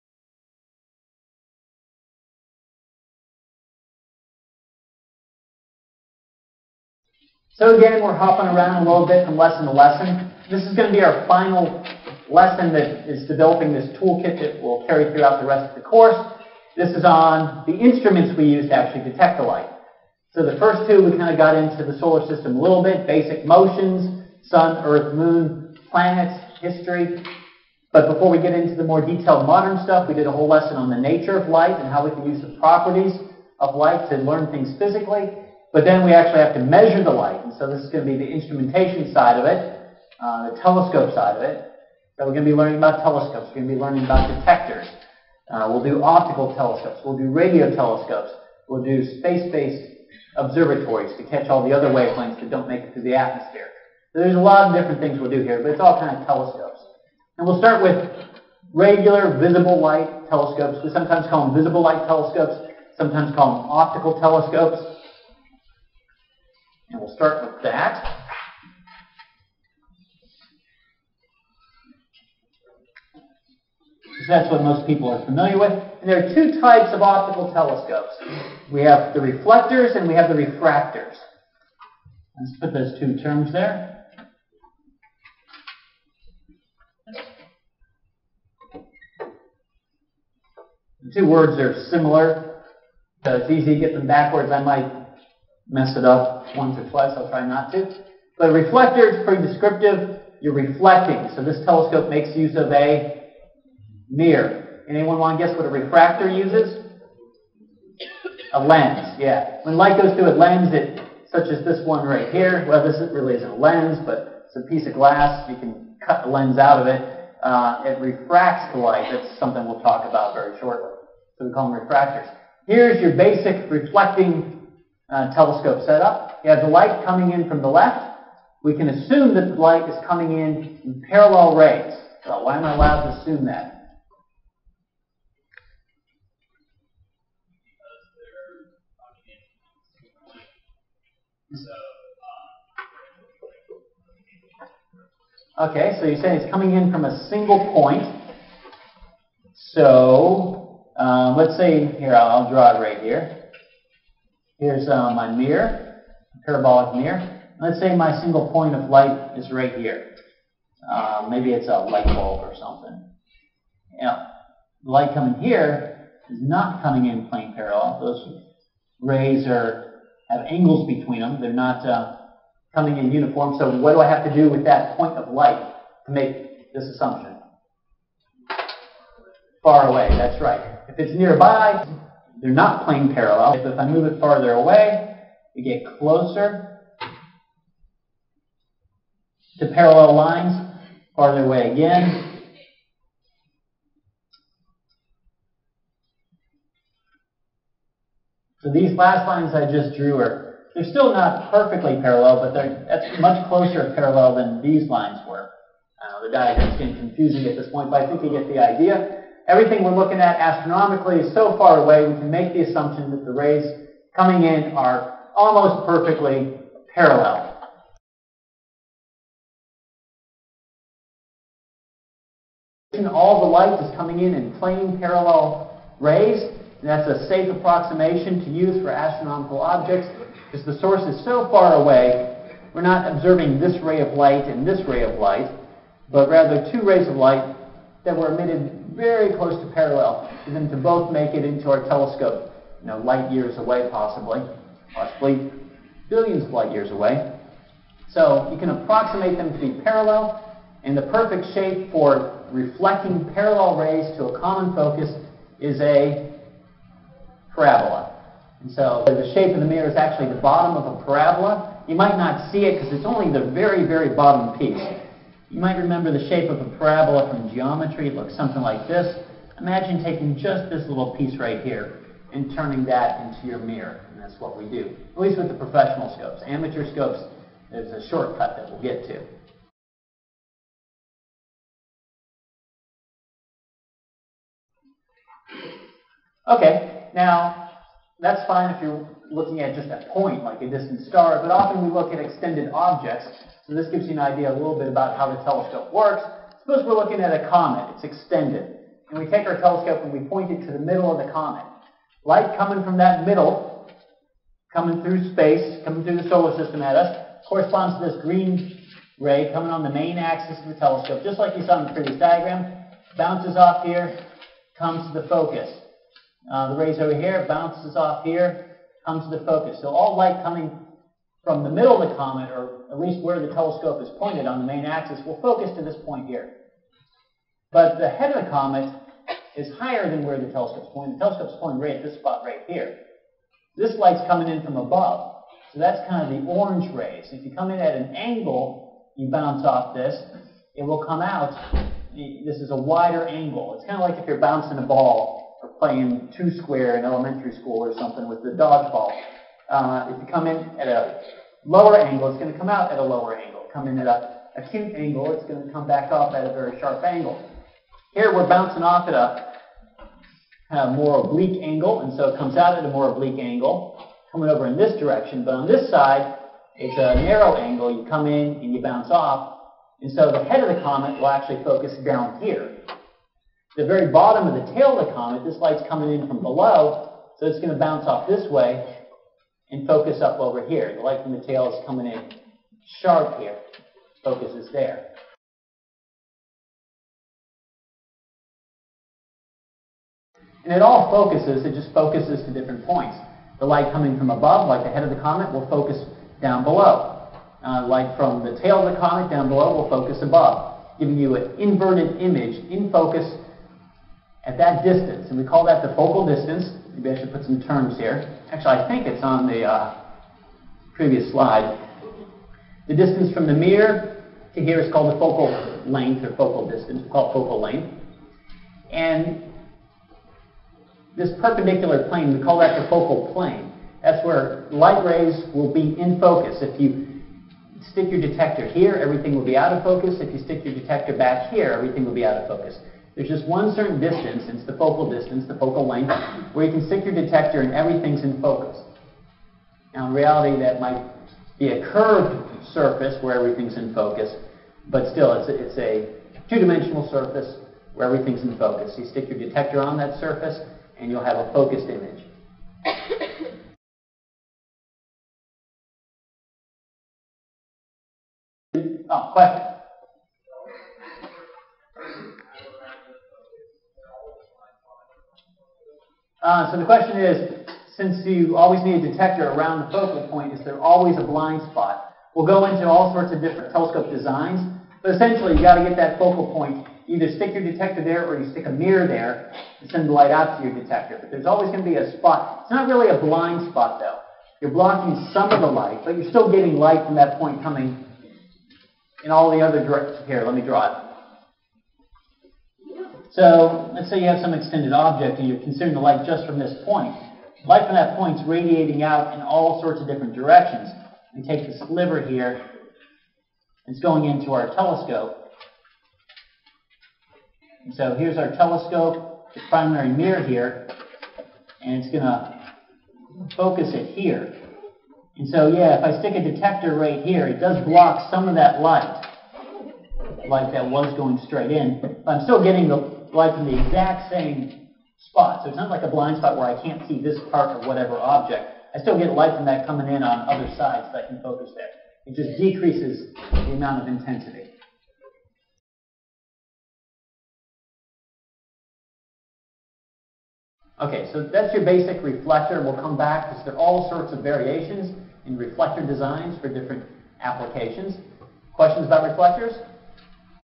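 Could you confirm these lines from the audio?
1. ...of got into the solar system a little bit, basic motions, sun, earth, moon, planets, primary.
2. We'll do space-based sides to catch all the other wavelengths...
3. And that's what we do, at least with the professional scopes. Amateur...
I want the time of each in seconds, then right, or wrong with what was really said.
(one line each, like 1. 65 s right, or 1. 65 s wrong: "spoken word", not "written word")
1. 21 s wrong: "history", not "primary"
2. 48 s wrong: "observatories", not "sides"
3. 274 s right.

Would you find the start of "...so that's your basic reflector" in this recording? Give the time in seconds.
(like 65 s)
541 s.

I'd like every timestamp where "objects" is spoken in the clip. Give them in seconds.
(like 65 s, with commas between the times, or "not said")
229 s, 292 s, 494 s, 528 s.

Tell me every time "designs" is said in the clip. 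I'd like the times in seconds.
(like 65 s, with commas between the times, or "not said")
474 s, 546 s.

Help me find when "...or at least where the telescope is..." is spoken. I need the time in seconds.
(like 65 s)
322 s.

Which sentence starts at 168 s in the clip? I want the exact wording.
Those rays are have angles between them.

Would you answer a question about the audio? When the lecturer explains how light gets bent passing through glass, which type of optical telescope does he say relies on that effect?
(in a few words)
Refractor.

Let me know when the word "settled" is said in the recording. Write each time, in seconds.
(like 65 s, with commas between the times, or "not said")
not said.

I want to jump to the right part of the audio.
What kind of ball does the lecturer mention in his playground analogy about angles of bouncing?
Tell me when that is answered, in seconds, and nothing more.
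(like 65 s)
348 s.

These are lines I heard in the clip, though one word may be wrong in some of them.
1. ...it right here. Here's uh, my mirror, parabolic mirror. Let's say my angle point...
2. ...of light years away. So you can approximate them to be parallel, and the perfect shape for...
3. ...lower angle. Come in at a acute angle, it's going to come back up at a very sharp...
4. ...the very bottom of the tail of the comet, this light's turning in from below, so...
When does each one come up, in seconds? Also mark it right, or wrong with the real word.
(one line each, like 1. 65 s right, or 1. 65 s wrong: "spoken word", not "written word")
1. 152 s wrong: "single", not "angle"
2. 246 s right
3. 353 s right
4. 373 s wrong: "coming", not "turning".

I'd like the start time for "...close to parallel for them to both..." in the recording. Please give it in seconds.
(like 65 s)
239 s.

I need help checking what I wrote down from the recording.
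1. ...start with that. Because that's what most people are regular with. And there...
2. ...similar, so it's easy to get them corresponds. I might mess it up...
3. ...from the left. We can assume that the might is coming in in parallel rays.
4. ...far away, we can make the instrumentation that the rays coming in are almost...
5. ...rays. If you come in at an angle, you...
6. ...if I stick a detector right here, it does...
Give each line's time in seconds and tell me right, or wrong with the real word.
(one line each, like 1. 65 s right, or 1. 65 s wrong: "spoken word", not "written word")
1. 67 s wrong: "familiar", not "regular"
2. 91 s wrong: "backwards", not "corresponds"
3. 127 s wrong: "light", not "might"
4. 211 s wrong: "assumption", not "instrumentation"
5. 336 s right
6. 515 s right.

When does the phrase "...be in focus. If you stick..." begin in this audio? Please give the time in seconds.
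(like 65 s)
425 s.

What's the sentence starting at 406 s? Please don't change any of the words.
Maybe I should put some terms here.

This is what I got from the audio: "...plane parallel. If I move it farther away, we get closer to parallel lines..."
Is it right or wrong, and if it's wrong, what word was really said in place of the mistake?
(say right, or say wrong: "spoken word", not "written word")
right.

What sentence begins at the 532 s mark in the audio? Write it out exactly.
It just decreases the amount of intensity.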